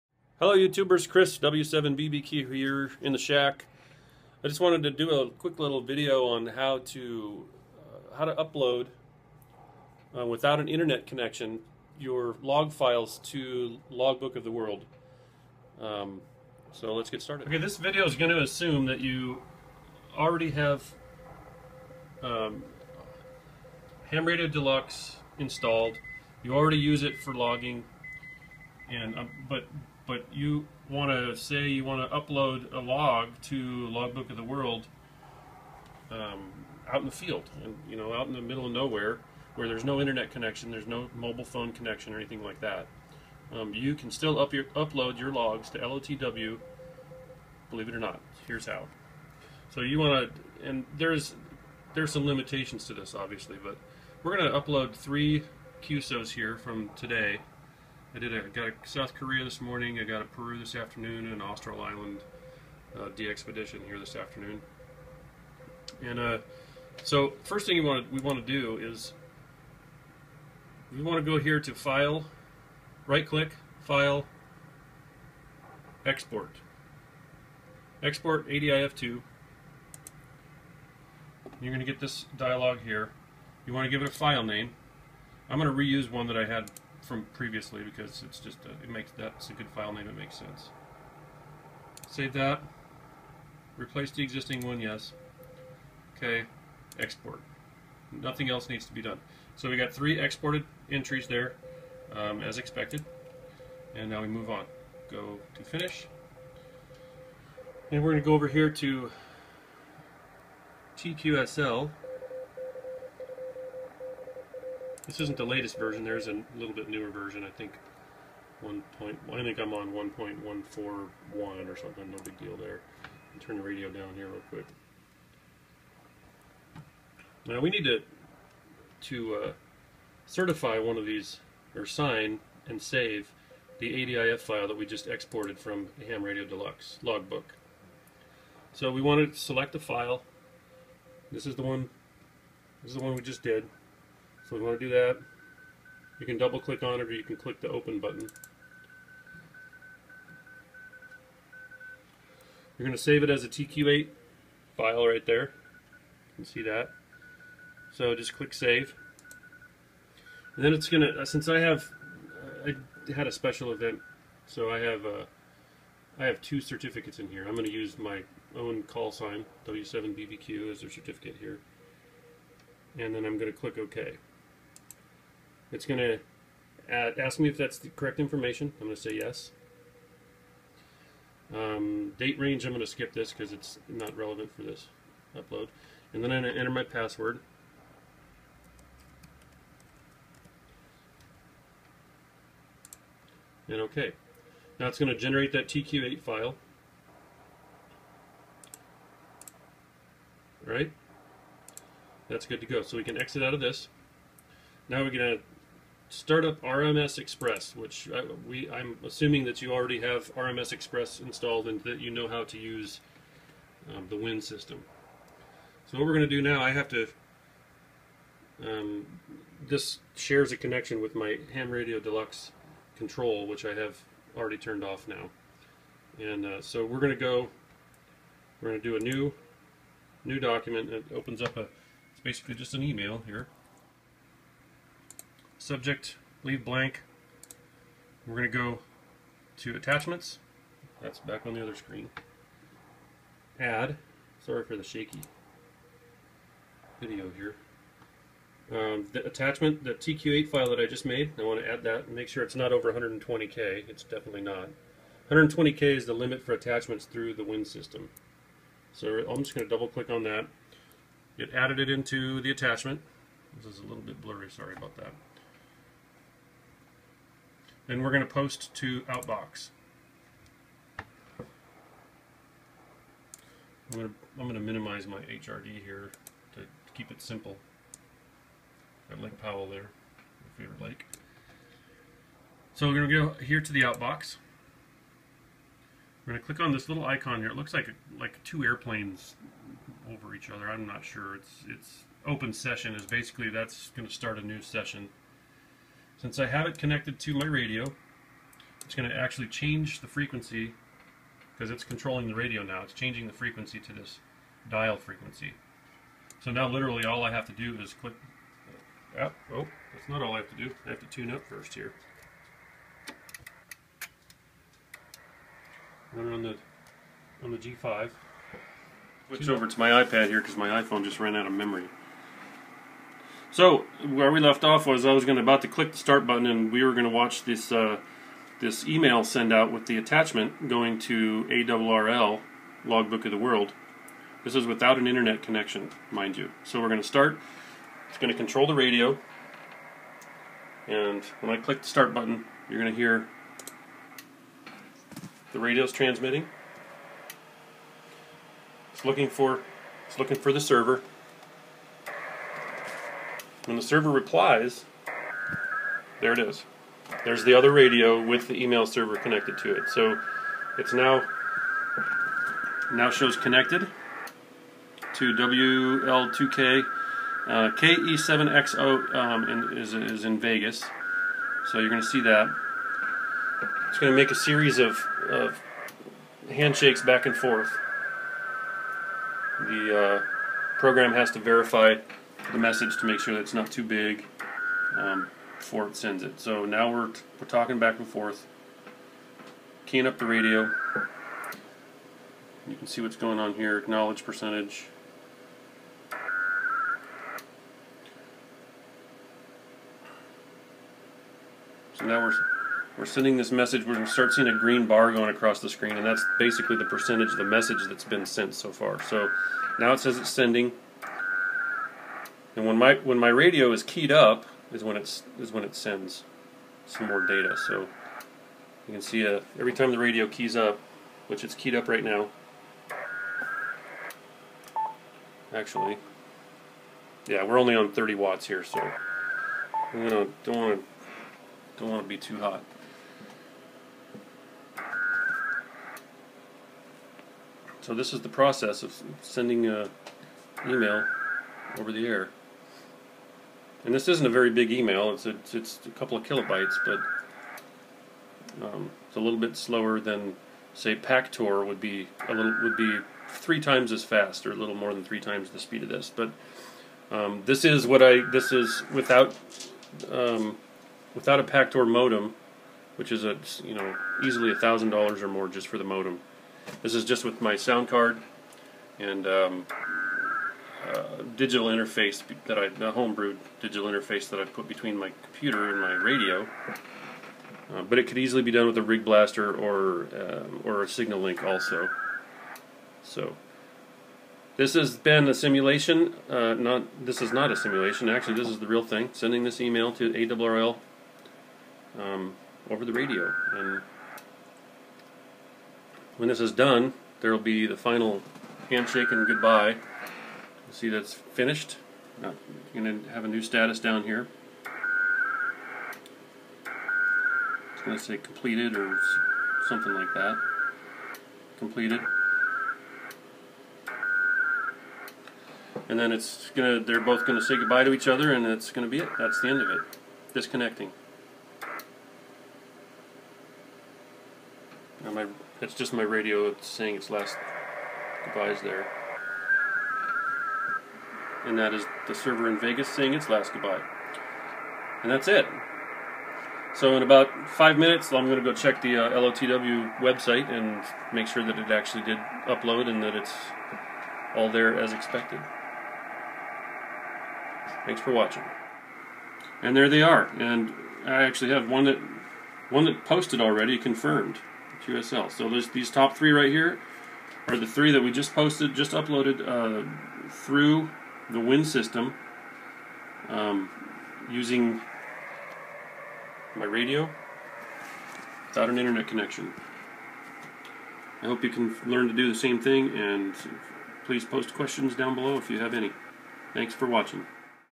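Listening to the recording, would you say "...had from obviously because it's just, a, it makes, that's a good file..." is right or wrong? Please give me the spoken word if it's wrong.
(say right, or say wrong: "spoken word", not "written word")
wrong: "previously", not "obviously".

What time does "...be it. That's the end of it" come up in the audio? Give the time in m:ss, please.
8:38.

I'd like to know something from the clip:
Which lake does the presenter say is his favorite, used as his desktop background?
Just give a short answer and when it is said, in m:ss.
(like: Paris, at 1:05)
Lake Powell, at 4:39.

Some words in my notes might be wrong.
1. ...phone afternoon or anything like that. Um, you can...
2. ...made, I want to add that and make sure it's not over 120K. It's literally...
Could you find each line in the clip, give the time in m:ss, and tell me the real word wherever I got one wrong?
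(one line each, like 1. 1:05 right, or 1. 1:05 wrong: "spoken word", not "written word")
1. 0:41 wrong: "connection", not "afternoon"
2. 4:11 wrong: "definitely", not "literally".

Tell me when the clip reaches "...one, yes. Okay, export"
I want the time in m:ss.
1:34.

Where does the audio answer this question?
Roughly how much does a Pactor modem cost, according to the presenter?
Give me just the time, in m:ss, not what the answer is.
7:44.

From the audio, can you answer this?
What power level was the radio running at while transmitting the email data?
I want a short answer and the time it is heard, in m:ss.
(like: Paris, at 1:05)
30 watts, at 7:07.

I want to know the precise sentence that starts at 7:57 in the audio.
Uh, but it could easily be done with a Rig Blaster or um, or a SignaLink also.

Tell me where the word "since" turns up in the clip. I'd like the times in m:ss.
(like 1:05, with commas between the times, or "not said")
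2:41, 4:56.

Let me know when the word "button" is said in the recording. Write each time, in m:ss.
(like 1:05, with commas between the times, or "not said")
2:27, 5:26, 5:42.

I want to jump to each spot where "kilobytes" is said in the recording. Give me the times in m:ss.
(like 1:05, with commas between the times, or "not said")
7:26.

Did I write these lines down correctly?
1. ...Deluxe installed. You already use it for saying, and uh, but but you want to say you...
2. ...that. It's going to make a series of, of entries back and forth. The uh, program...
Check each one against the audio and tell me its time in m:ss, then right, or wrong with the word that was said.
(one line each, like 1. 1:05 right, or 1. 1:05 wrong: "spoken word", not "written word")
1. 0:24 wrong: "logging", not "saying"
2. 6:12 wrong: "handshakes", not "entries".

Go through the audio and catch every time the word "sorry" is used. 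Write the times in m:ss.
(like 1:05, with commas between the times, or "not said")
4:04, 4:24.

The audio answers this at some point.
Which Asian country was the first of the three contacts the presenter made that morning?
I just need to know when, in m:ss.
0:58.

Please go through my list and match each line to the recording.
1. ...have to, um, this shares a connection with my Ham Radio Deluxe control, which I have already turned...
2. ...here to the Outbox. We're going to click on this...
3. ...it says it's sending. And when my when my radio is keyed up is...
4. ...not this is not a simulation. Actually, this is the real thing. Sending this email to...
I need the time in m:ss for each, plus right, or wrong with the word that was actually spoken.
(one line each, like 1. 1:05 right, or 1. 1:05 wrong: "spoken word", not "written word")
1. 3:36 right
2. 4:43 right
3. 6:49 right
4. 8:06 right.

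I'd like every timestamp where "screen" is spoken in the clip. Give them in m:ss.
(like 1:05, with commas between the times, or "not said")
4:01, 6:45.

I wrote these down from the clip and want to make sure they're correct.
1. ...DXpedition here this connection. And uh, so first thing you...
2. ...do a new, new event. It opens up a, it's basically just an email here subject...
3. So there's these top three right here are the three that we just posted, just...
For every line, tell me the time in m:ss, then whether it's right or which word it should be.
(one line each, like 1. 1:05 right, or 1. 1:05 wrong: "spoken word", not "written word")
1. 1:03 wrong: "afternoon", not "connection"
2. 3:48 wrong: "document", not "event"
3. 9:15 right.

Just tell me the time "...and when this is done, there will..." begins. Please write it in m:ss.
8:13.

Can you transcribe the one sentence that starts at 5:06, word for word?
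So now literally all I have to do is click...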